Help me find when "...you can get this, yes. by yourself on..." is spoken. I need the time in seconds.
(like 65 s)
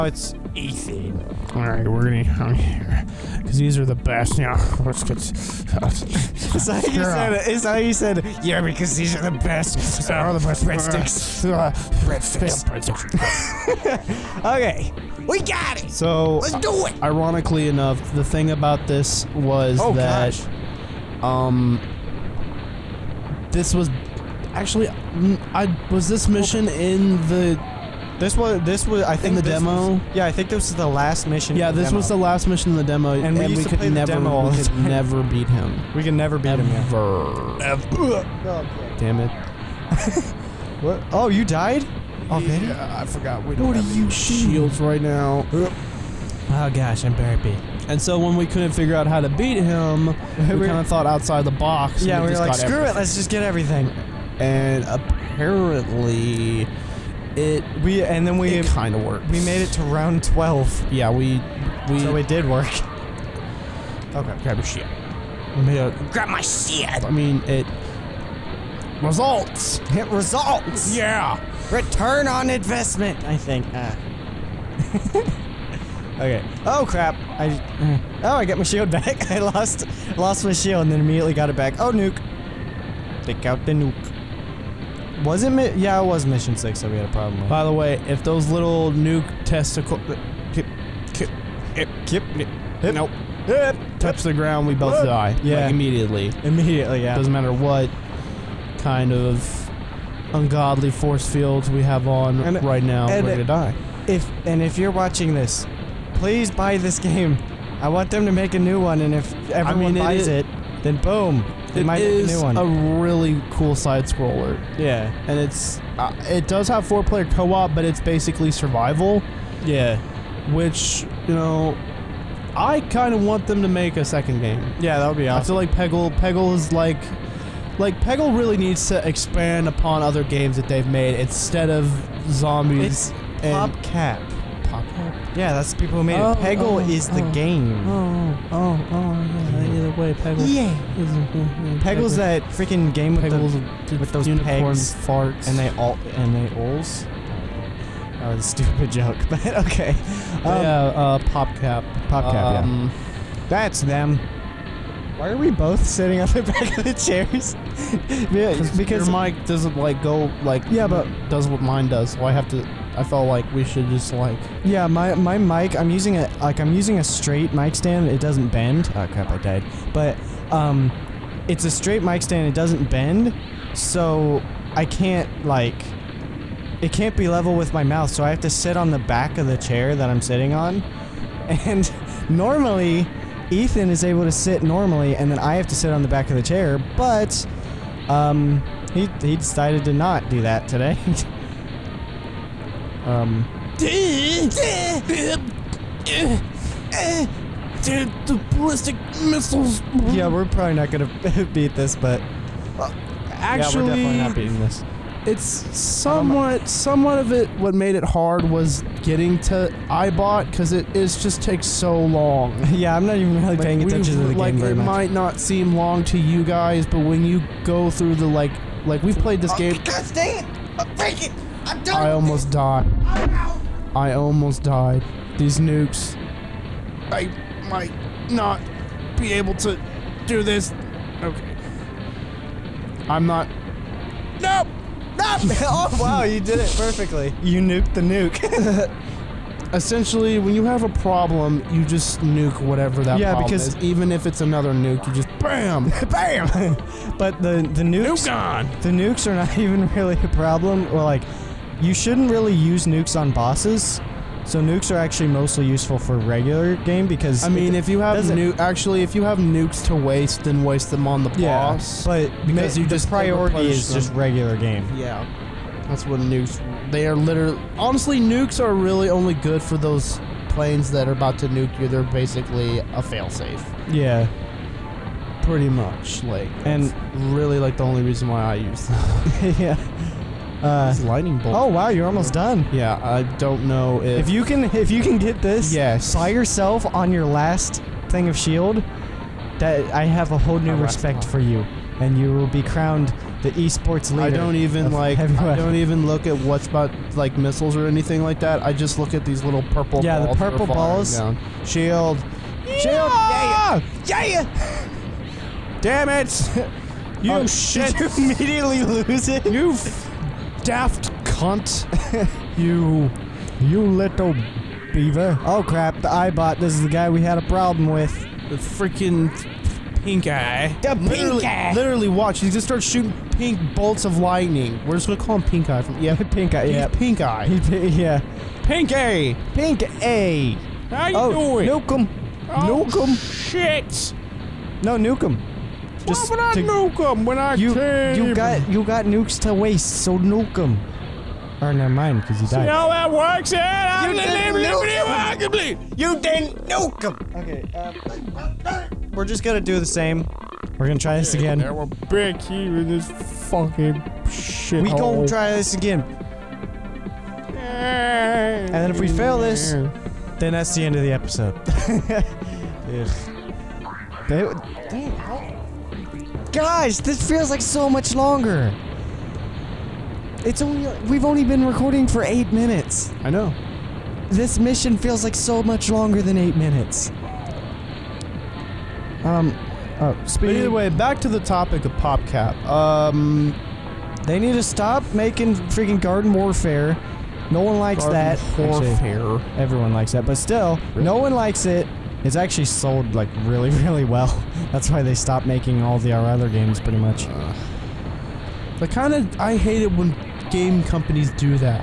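284 s.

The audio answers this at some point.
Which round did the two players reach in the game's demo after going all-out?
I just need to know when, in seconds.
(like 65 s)
60 s.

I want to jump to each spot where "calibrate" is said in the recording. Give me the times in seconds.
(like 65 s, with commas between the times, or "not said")
not said.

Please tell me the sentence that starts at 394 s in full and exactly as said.
That's why they stopped making all the our other games pretty much.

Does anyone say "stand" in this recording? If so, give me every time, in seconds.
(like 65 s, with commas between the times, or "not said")
167 s, 172 s.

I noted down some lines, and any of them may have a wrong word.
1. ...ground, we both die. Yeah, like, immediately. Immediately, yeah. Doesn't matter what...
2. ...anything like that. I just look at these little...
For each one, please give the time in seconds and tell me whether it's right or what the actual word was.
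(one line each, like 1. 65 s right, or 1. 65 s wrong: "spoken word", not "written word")
1. 94 s right
2. 297 s right.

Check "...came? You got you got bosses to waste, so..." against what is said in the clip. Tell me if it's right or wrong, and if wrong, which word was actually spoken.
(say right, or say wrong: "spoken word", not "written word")
wrong: "nukes", not "bosses".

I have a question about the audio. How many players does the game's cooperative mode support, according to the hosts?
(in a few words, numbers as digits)
4.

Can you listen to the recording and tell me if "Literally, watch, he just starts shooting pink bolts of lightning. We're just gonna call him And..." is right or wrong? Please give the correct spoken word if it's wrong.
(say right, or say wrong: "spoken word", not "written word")
wrong: "Pink", not "And".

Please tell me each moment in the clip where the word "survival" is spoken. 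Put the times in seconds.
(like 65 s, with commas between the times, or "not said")
118 s.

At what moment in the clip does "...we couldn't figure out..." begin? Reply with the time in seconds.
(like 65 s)
48 s.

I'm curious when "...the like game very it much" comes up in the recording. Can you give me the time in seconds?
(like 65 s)
214 s.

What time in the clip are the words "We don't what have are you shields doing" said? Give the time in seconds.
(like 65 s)
43 s.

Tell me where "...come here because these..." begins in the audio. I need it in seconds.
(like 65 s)
2 s.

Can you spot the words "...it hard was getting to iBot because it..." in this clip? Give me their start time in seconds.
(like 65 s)
207 s.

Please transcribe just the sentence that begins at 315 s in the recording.
Oh crap, the iBot, this is the guy we had a problem with.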